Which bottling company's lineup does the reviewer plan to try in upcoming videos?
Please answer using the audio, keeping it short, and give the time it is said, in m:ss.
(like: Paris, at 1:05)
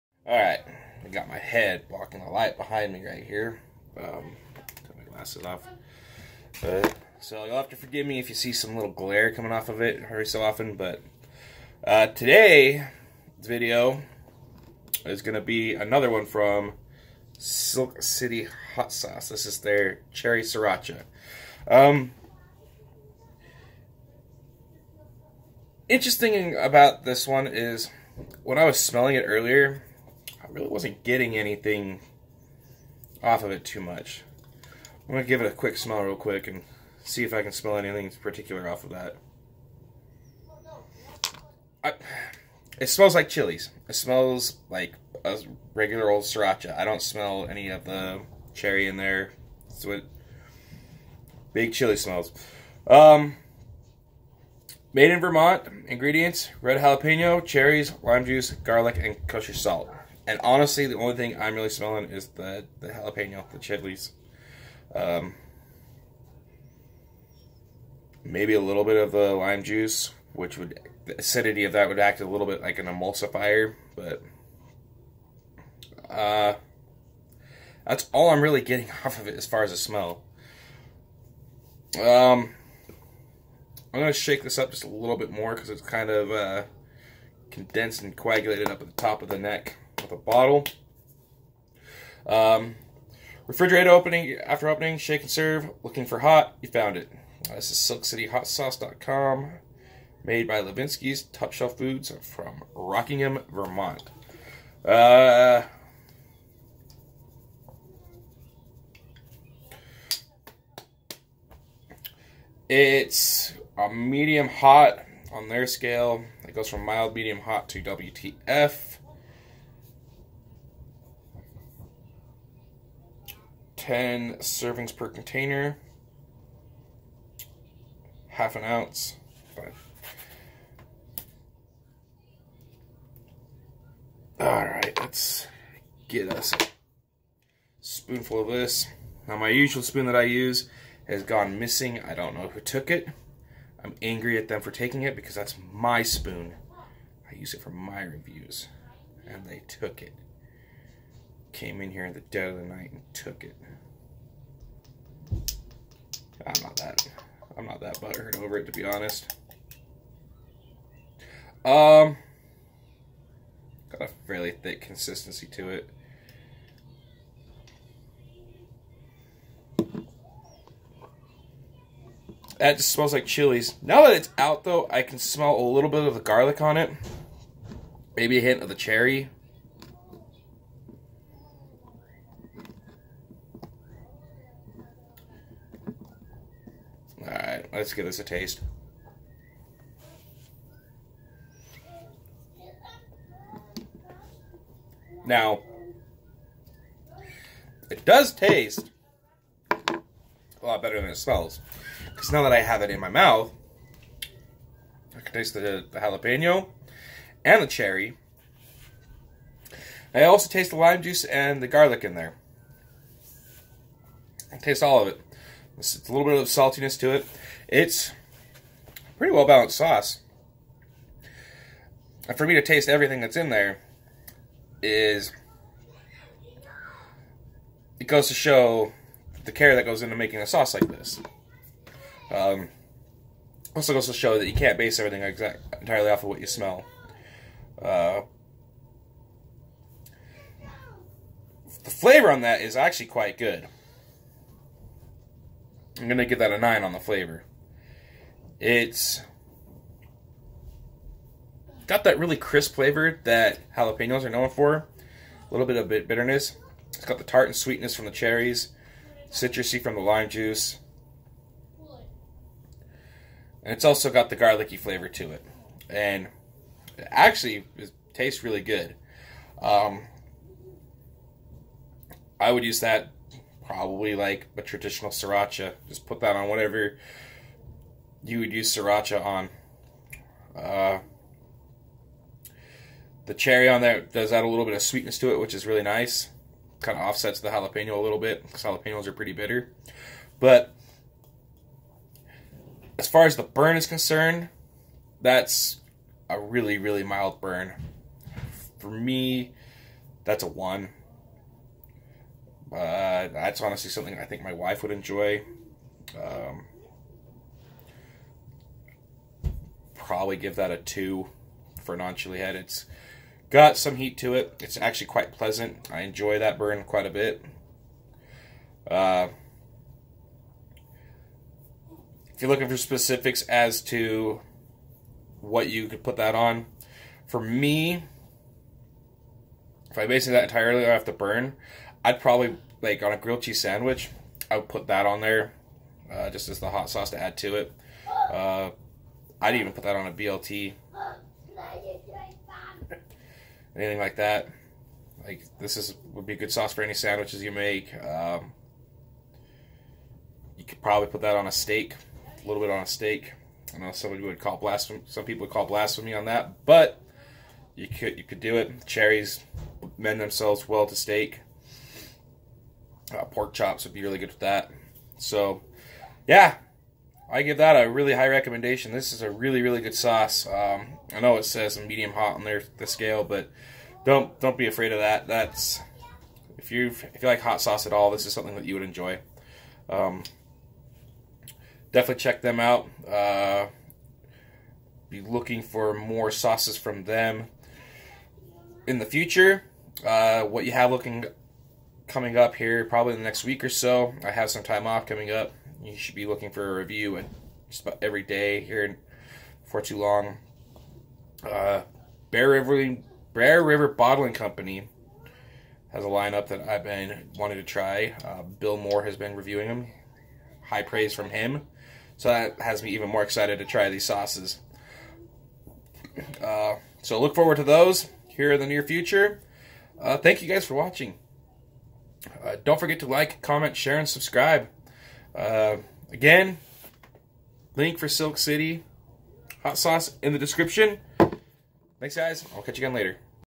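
Bear River Bottling Company, at 6:43.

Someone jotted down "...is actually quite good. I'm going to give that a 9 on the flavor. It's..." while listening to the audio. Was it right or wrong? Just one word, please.
right.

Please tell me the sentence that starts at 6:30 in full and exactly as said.
Uh, what you have looking coming up here, probably in the next week or so.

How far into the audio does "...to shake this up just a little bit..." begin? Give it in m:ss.
1:24.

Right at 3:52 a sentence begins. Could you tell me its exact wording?
Um, also goes to show that you can't base everything exact, entirely off of what you smell.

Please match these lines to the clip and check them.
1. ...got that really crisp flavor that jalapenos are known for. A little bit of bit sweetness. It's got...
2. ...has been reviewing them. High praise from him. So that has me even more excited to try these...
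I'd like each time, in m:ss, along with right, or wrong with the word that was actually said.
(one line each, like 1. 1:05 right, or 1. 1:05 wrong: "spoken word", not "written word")
1. 4:11 wrong: "bitterness", not "sweetness"
2. 6:49 right.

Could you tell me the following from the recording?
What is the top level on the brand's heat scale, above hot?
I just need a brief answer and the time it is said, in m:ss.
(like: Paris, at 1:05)
WTF, at 1:57.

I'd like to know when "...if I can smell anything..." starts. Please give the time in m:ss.
0:37.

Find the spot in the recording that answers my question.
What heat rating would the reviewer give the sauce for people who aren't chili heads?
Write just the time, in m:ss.
5:10.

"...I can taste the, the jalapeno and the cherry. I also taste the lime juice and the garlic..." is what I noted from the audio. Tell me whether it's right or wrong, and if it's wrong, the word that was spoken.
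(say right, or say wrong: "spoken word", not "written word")
right.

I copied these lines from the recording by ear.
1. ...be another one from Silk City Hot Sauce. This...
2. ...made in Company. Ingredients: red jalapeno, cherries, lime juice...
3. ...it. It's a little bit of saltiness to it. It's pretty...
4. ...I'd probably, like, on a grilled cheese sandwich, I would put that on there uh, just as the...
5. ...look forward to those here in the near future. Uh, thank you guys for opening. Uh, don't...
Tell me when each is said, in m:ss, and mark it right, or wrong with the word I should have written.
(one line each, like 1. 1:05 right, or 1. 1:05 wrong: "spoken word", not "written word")
1. 0:15 right
2. 0:54 wrong: "Vermont", not "Company"
3. 3:35 right
4. 5:32 right
5. 6:57 wrong: "watching", not "opening".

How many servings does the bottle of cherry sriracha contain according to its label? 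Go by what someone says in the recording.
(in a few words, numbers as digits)
10.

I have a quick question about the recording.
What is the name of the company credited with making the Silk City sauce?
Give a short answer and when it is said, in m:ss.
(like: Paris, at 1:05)
Levinsky's Top Shelf Foods, at 1:40.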